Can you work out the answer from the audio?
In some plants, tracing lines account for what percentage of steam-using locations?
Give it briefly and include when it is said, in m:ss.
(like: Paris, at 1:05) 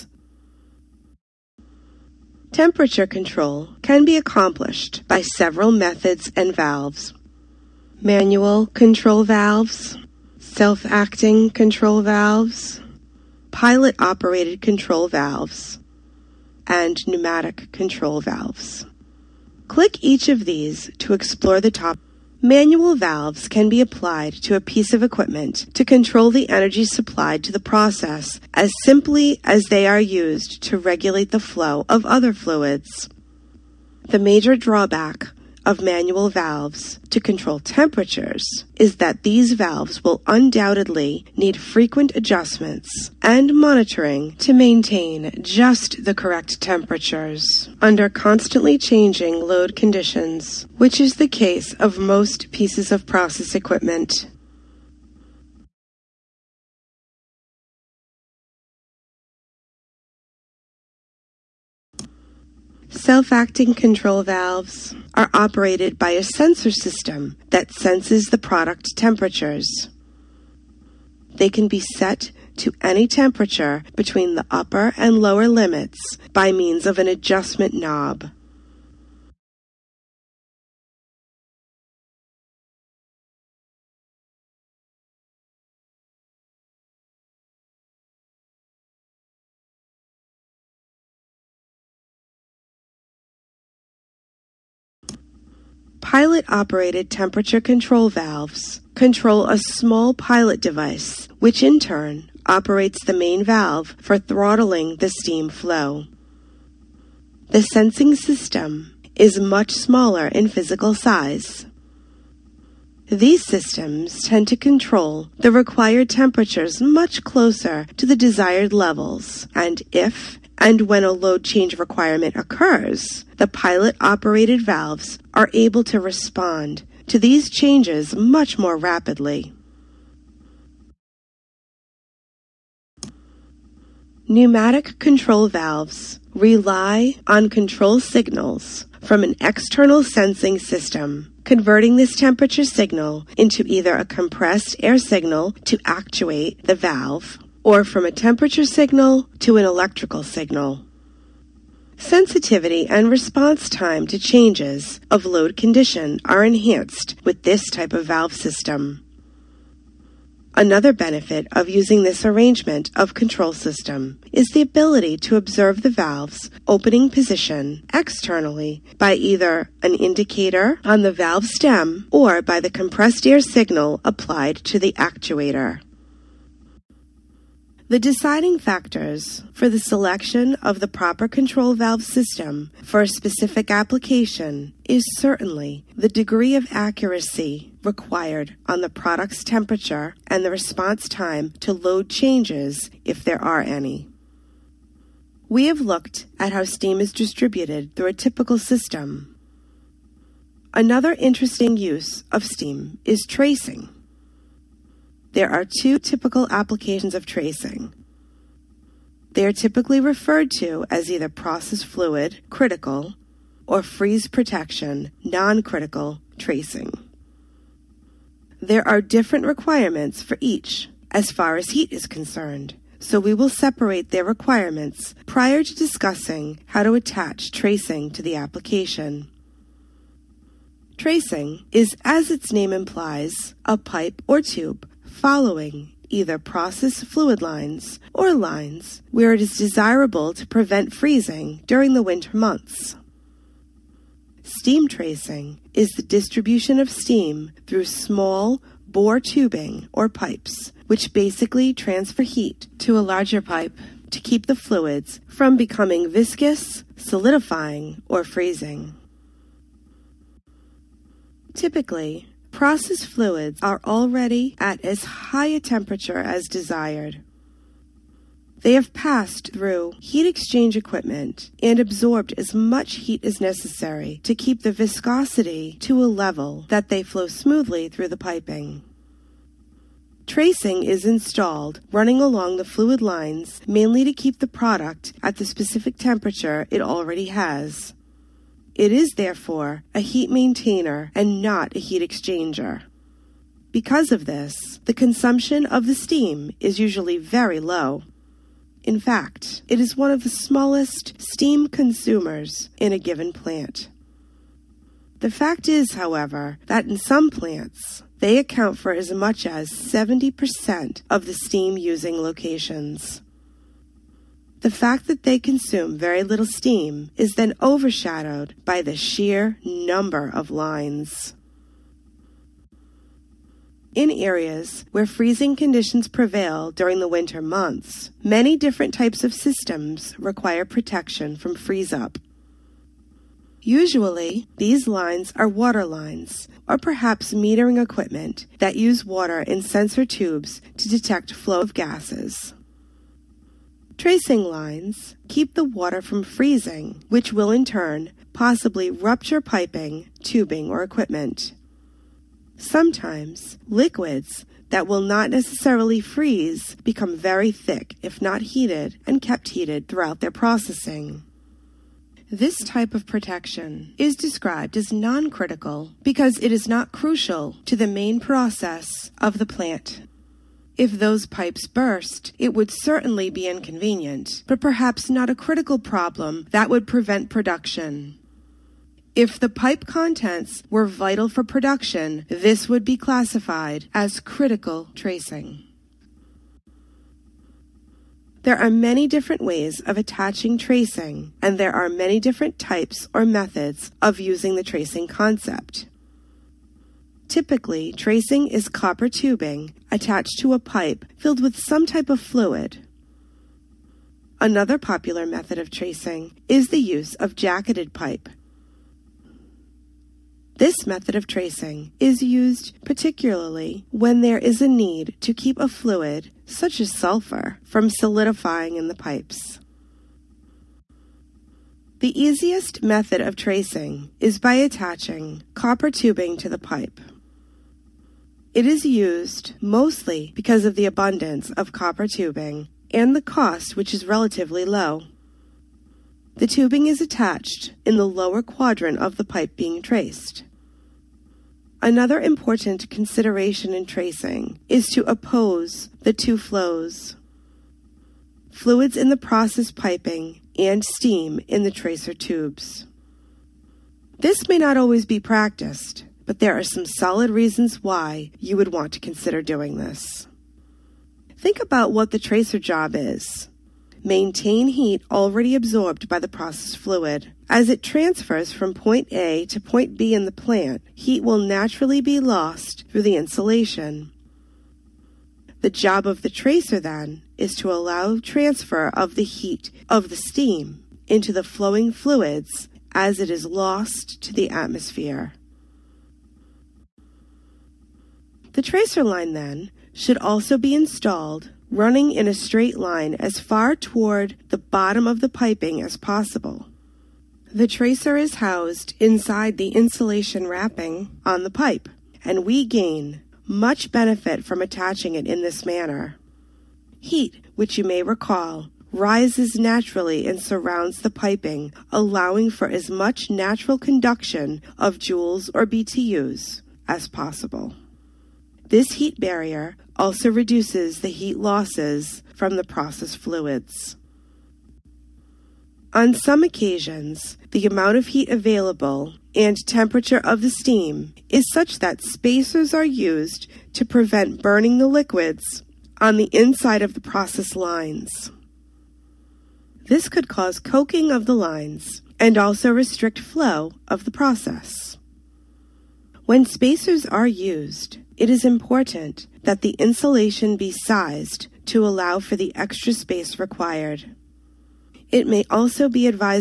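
70%, at 5:09.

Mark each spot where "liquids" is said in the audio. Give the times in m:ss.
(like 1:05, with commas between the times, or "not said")
5:53, 8:54.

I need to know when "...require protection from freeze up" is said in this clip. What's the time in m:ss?
5:30.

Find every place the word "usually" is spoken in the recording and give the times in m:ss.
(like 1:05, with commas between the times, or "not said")
4:56, 5:33.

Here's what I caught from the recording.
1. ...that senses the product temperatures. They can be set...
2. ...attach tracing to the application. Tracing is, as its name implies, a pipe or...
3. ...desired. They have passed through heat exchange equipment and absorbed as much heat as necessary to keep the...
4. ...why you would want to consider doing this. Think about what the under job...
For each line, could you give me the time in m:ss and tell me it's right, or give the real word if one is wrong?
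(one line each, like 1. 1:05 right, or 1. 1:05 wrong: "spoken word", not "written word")
1. 1:07 right
2. 3:46 right
3. 4:26 right
4. 7:37 wrong: "tracer", not "under".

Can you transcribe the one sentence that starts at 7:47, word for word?
As it transfers from point A to point B in the plant, heat will naturally be lost through the insulation.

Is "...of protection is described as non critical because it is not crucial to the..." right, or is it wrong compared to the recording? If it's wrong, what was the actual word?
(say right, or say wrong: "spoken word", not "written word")
right.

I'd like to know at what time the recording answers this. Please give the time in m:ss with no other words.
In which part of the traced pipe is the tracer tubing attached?
7:18.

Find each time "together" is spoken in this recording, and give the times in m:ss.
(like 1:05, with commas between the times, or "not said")
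not said.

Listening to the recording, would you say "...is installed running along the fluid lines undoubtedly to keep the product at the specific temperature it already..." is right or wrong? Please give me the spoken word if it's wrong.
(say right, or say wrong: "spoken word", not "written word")
wrong: "mainly", not "undoubtedly".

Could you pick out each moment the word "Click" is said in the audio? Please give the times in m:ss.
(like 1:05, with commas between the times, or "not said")
0:19.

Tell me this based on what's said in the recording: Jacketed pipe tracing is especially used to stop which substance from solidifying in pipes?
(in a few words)
sulfur.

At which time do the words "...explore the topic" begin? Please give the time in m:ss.
0:21.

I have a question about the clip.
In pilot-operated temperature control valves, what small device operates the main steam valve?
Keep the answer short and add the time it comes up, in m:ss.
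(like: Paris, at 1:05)
pilot device, at 1:40.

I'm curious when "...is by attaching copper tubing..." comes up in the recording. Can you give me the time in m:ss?
7:04.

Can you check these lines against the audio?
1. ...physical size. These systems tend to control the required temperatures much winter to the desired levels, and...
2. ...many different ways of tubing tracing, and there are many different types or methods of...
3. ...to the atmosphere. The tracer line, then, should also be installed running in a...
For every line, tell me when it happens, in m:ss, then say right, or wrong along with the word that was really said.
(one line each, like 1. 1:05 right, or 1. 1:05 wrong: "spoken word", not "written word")
1. 1:50 wrong: "closer", not "winter"
2. 6:28 wrong: "attaching", not "tubing"
3. 8:04 right.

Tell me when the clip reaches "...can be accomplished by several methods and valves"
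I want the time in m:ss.
0:03.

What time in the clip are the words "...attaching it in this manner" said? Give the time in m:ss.
8:24.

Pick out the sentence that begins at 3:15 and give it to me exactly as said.
We have looked at how steam is distributed through a typical system.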